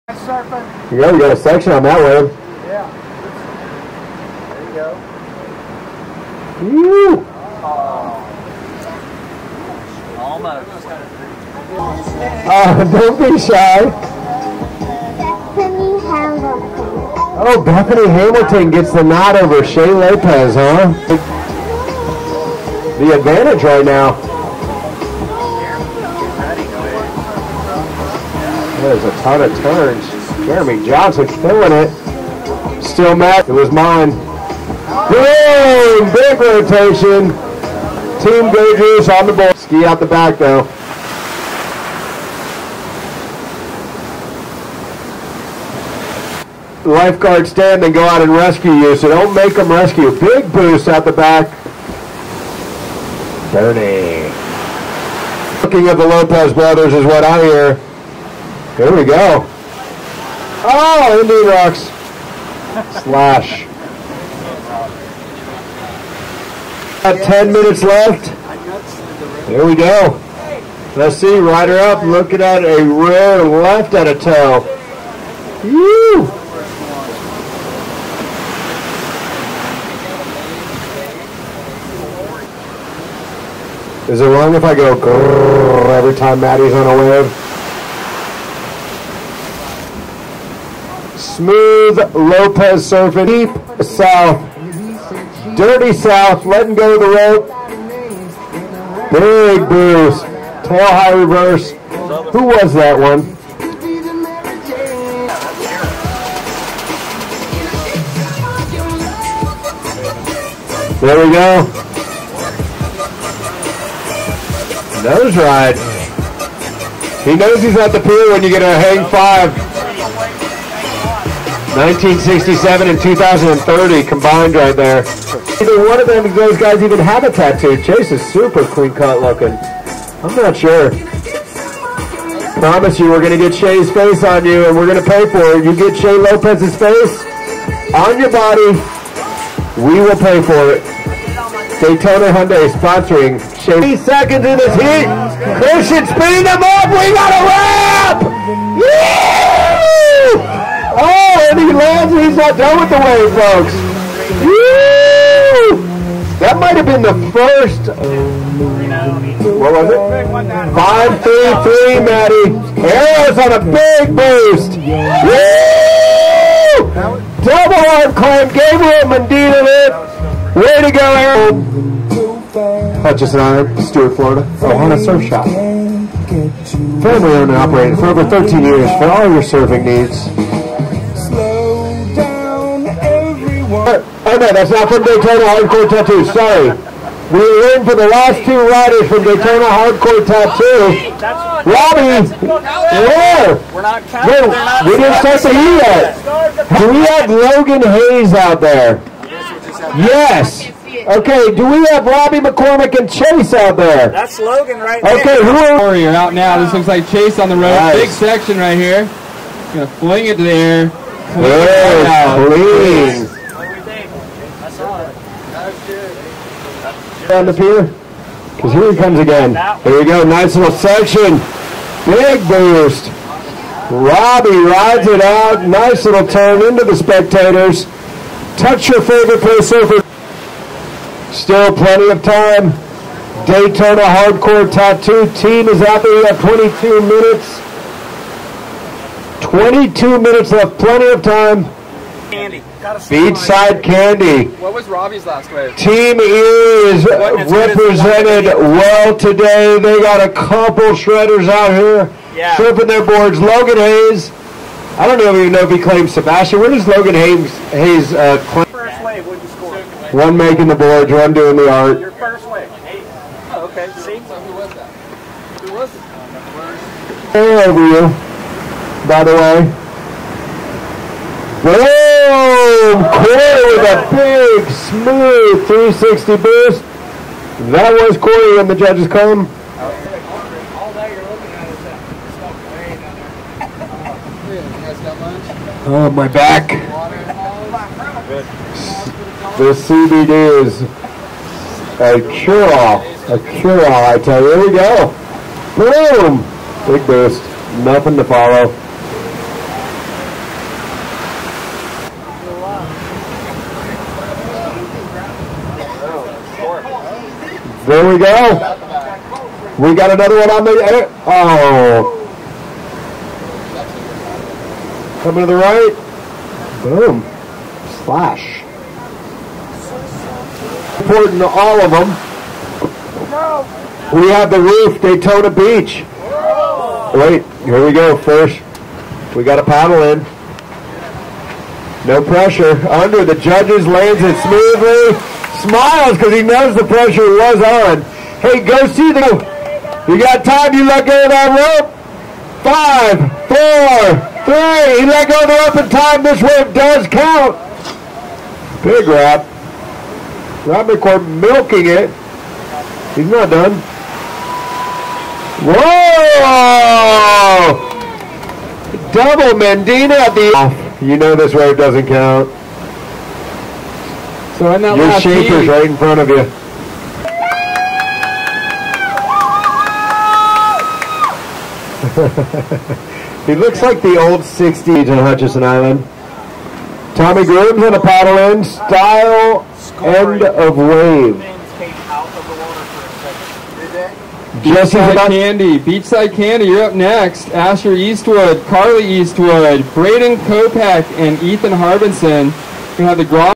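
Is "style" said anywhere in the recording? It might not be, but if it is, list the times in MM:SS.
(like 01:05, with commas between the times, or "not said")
06:18.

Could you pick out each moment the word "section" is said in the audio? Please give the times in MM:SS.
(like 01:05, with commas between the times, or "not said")
00:01, 03:28, 03:40.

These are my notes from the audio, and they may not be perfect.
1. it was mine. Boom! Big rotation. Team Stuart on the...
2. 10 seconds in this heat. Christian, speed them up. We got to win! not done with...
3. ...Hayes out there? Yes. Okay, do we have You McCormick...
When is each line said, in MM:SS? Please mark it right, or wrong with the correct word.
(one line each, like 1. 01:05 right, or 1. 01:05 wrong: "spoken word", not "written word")
1. 00:33 wrong: "Gagers", not "Stuart"
2. 02:23 wrong: "30", not "10"
3. 03:17 wrong: "Robbie", not "You".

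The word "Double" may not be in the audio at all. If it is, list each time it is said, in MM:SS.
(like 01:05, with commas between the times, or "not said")
02:47, 05:59.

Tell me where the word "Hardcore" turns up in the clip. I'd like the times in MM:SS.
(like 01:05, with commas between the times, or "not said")
03:05, 03:09, 03:54.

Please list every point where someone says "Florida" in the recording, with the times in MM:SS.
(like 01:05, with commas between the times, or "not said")
02:54.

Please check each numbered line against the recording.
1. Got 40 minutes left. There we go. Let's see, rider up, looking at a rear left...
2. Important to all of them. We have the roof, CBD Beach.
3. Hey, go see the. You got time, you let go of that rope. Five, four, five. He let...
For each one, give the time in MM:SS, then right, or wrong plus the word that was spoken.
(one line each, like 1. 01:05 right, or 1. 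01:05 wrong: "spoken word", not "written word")
1. 01:07 wrong: "10", not "40"
2. 05:21 wrong: "Daytona", not "CBD"
3. 05:38 wrong: "three", not "five".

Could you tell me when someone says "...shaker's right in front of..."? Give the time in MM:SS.
06:05.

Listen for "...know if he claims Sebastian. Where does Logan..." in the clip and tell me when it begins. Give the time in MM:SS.
04:15.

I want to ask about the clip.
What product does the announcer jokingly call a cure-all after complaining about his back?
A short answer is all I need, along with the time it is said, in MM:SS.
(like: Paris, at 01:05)
CBD, at 04:49.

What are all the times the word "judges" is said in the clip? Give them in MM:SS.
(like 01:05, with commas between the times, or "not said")
04:38, 05:33.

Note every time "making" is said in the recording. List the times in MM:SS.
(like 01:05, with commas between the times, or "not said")
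04:20.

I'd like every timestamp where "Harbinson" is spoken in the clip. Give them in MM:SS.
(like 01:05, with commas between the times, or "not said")
06:31.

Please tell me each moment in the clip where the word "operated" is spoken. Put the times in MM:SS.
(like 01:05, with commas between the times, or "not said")
02:57.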